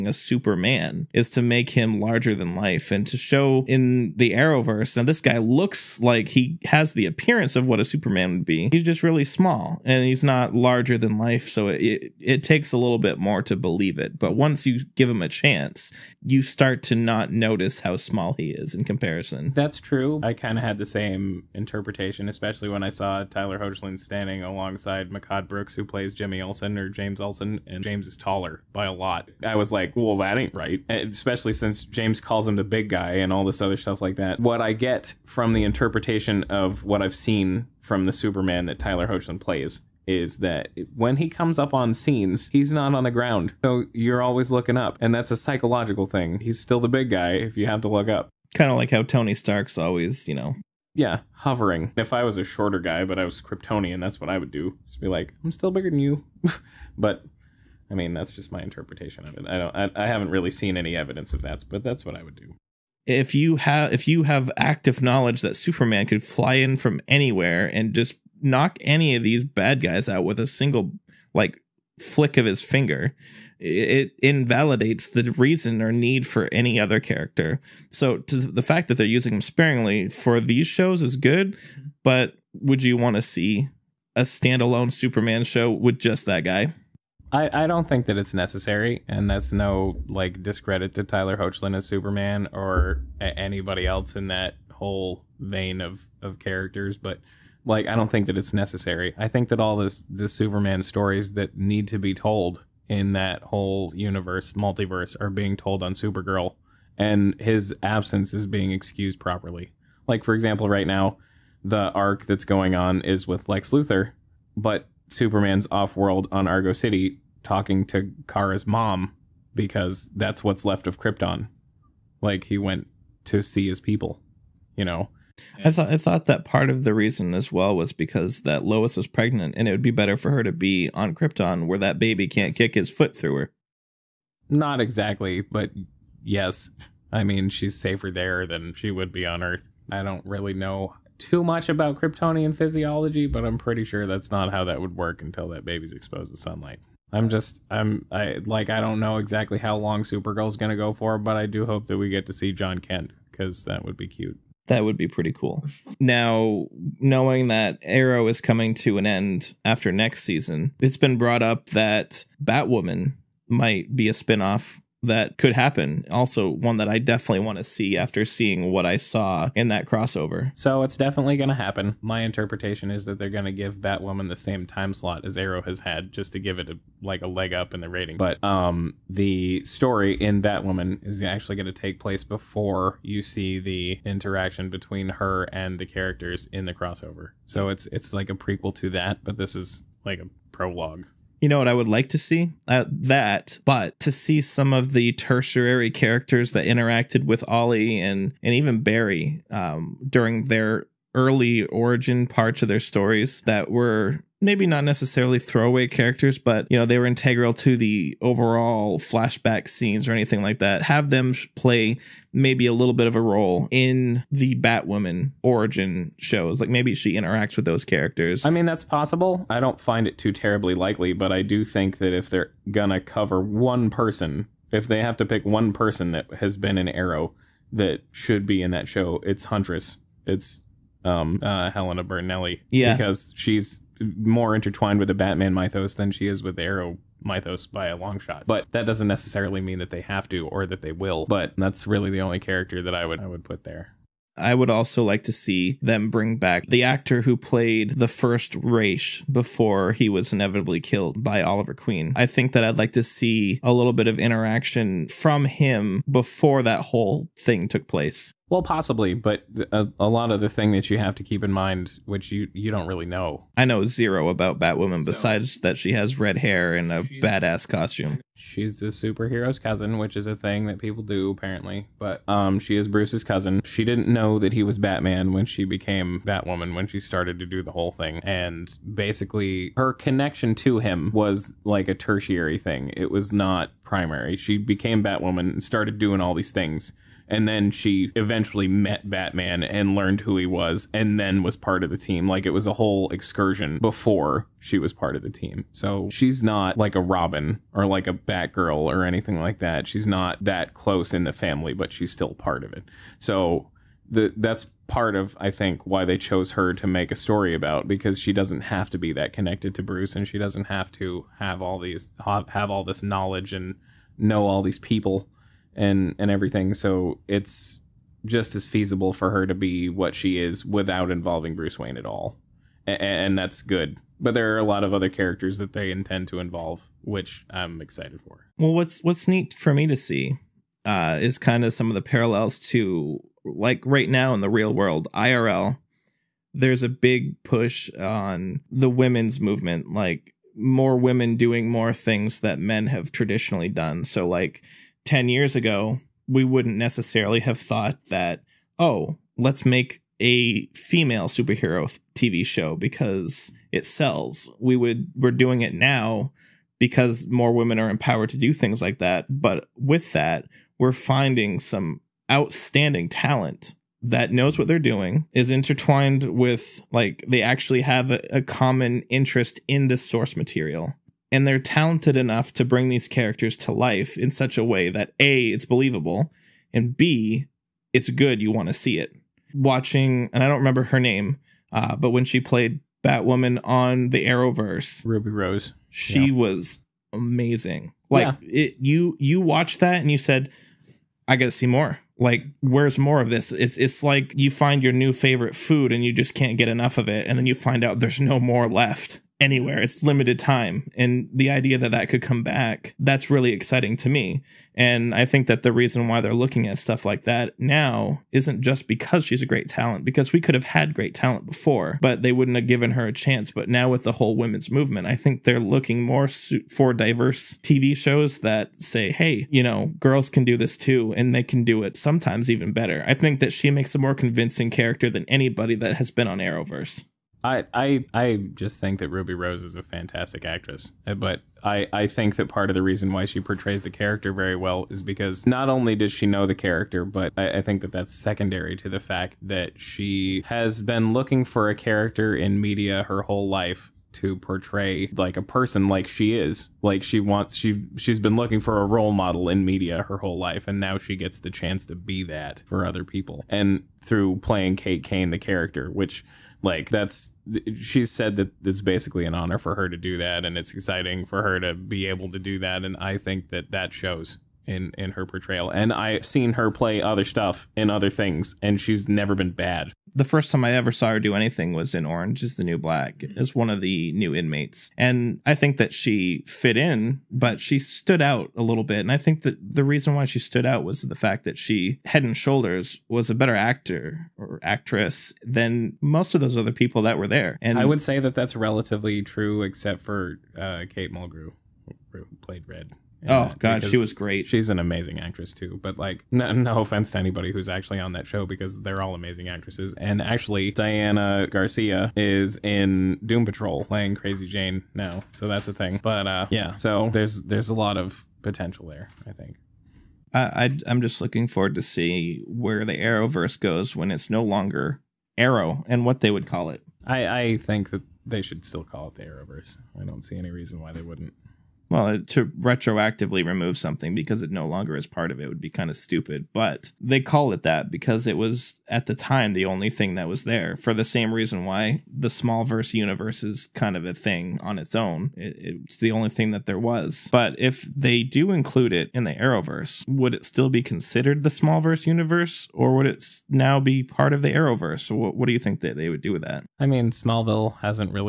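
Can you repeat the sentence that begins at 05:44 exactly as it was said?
So like 10 years ago, we wouldn't necessarily have thought that, oh, let's make a female superhero TV show because it sells.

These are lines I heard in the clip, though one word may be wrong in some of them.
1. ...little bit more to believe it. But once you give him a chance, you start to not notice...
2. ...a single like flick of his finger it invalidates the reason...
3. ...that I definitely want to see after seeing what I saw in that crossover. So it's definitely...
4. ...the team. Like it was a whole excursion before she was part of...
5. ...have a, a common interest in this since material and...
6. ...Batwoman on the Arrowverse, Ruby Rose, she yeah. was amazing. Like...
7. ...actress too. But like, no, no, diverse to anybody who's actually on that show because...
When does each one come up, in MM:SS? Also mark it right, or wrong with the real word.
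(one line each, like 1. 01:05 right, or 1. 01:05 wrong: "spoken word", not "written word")
1. 00:12 right
2. 01:10 right
3. 02:46 right
4. 04:51 right
5. 06:07 wrong: "source", not "since"
6. 06:23 right
7. 08:15 wrong: "offense", not "diverse".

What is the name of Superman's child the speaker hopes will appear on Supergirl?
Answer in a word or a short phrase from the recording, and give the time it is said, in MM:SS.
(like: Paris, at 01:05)
Jon Kent, at 02:32.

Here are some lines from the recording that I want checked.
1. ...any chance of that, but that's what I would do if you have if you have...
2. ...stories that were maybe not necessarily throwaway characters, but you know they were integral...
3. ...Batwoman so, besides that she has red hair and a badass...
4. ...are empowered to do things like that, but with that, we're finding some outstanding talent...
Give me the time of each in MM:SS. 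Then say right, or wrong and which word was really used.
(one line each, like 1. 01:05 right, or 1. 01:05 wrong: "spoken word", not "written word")
1. 01:00 wrong: "evidence", not "chance"
2. 03:22 right
3. 04:24 right
4. 05:57 right.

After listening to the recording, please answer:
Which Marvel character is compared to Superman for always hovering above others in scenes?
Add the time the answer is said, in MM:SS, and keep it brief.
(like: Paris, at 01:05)
Tony Stark, at 00:49.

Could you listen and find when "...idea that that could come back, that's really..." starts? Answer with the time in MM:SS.
06:41.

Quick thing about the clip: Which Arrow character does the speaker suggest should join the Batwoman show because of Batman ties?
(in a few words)
Helena Bertinelli.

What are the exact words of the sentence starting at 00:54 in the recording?
Just be like, I'm still bigger than you.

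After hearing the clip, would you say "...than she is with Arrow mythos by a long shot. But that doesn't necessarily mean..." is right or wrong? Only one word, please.
right.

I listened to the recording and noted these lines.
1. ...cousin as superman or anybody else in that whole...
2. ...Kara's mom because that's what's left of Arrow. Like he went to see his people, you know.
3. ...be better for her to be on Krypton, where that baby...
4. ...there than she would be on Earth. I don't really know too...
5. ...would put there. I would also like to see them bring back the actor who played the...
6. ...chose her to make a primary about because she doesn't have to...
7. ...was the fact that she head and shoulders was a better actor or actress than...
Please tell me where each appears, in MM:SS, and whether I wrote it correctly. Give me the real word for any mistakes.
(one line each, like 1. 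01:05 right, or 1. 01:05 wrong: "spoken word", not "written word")
1. 01:31 wrong: "hoechlin", not "cousin"
2. 01:58 wrong: "Krypton", not "Arrow"
3. 02:09 right
4. 02:18 right
5. 04:03 right
6. 05:06 wrong: "story", not "primary"
7. 08:00 right.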